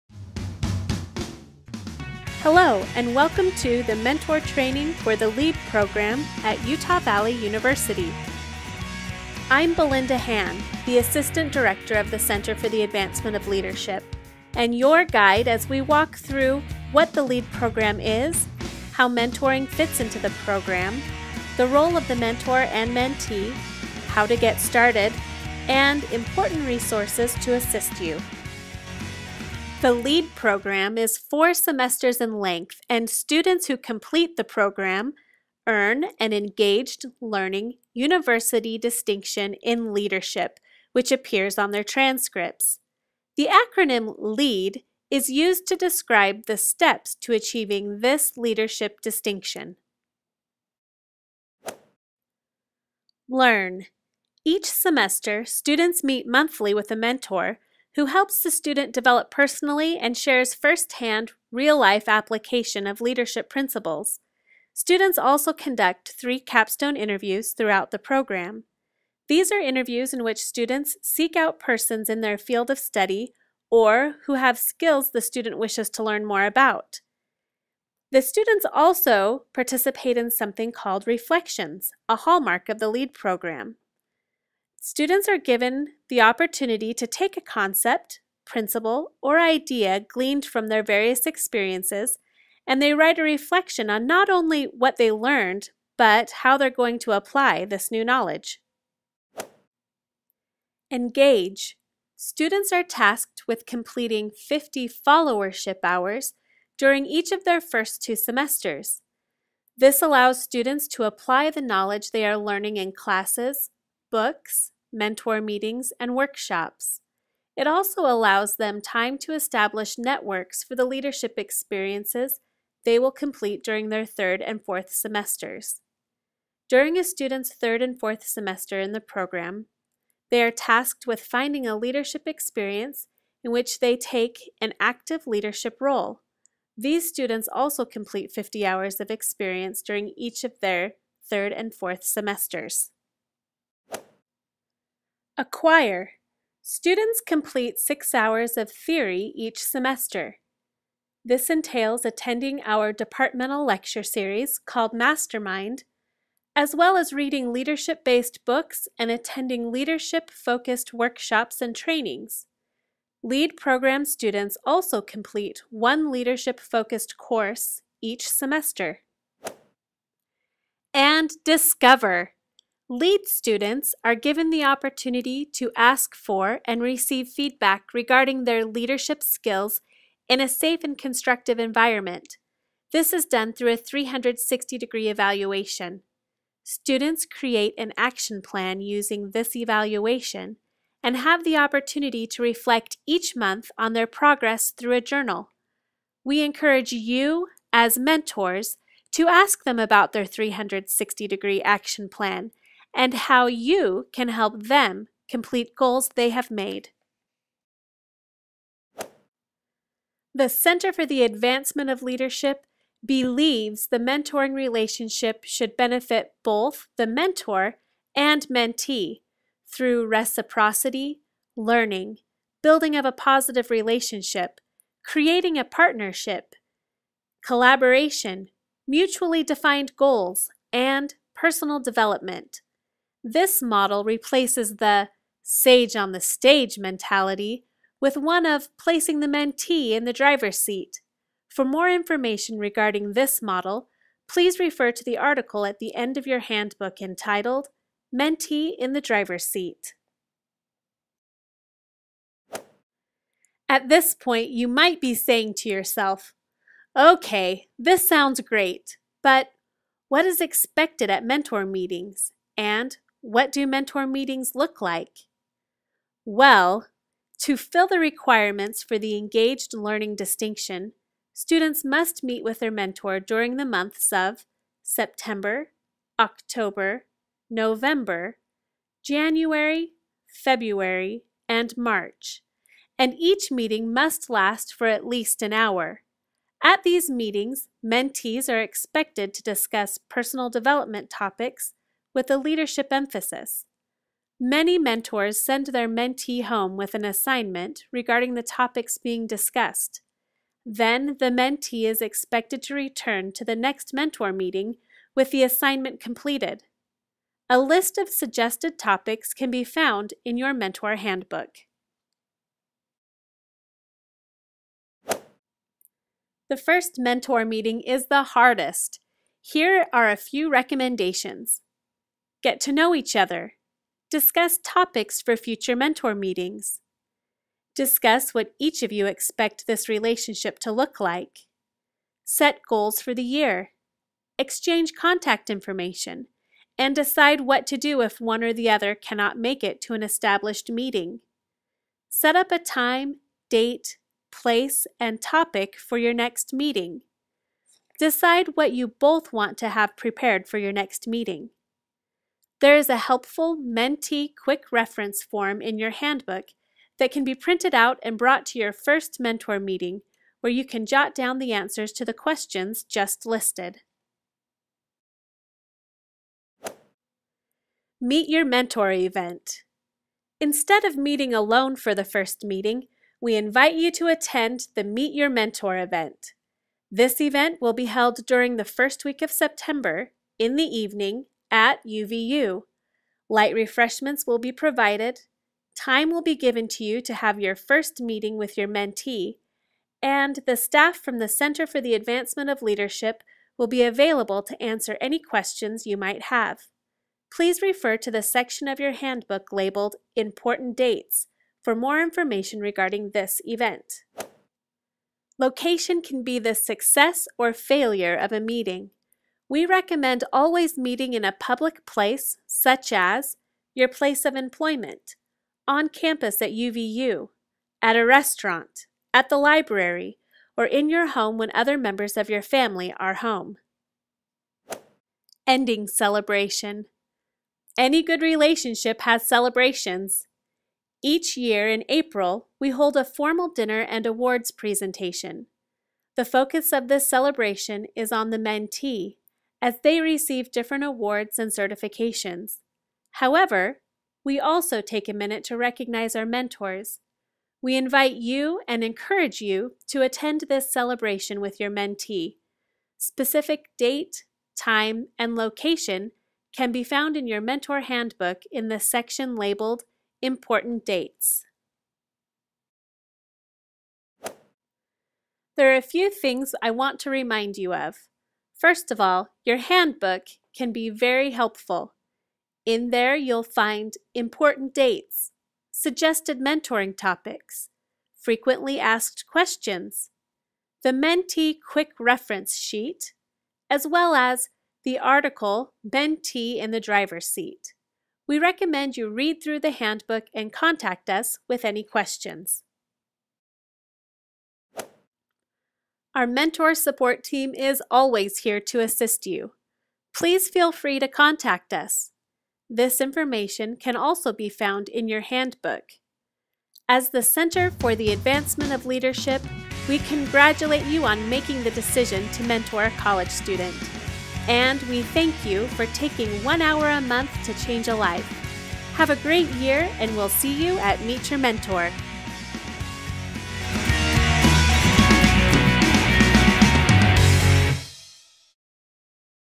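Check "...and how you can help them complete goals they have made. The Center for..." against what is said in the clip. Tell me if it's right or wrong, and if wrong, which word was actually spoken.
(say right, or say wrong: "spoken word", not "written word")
right.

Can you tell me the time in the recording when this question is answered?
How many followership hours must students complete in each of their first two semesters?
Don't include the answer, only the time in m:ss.
1:44.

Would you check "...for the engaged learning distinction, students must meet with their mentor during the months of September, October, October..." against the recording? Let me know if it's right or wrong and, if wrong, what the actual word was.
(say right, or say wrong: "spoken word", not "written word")
wrong: "November", not "October".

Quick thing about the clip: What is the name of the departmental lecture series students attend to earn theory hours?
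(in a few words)
Mastermind.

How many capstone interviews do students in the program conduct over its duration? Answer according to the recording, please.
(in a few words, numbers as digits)
3.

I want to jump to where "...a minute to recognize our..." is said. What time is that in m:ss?
7:25.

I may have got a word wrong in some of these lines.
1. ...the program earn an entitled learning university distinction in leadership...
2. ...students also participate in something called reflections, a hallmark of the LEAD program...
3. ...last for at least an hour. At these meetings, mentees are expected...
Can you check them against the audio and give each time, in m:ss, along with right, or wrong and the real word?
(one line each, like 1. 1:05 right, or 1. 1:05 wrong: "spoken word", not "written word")
1. 0:34 wrong: "engaged", not "entitled"
2. 1:18 right
3. 4:44 right.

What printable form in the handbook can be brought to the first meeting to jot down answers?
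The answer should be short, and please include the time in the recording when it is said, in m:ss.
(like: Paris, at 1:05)
Mentee quick reference form, at 5:53.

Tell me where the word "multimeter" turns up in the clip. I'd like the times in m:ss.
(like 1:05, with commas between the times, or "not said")
not said.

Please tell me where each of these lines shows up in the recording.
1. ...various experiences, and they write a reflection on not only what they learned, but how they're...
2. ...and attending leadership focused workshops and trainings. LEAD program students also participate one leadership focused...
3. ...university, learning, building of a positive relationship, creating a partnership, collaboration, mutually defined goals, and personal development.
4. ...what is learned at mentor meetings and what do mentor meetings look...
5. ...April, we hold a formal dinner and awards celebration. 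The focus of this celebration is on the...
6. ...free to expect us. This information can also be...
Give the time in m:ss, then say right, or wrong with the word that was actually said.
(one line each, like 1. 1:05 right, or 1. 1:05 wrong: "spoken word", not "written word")
1. 1:30 right
2. 2:38 wrong: "complete", not "participate"
3. 3:40 wrong: "reciprocity", not "university"
4. 4:20 wrong: "expected", not "learned"
5. 7:11 wrong: "presentation", not "celebration"
6. 8:20 wrong: "contact", not "expect".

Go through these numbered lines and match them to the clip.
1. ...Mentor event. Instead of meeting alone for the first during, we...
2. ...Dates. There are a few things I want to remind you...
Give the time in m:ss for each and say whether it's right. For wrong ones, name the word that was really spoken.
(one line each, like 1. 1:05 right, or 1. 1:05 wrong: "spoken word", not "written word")
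1. 6:08 wrong: "meeting", not "during"
2. 7:40 right.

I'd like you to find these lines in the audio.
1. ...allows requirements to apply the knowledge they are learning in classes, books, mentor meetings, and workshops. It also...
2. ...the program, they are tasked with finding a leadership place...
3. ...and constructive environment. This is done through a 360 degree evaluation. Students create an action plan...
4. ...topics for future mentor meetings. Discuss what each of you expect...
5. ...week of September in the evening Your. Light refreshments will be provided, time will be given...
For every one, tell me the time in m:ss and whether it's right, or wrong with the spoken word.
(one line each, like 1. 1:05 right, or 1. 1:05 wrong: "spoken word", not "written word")
1. 1:50 wrong: "students", not "requirements"
2. 2:08 wrong: "experience", not "place"
3. 3:00 right
4. 5:24 right
5. 6:19 wrong: "UVU", not "Your".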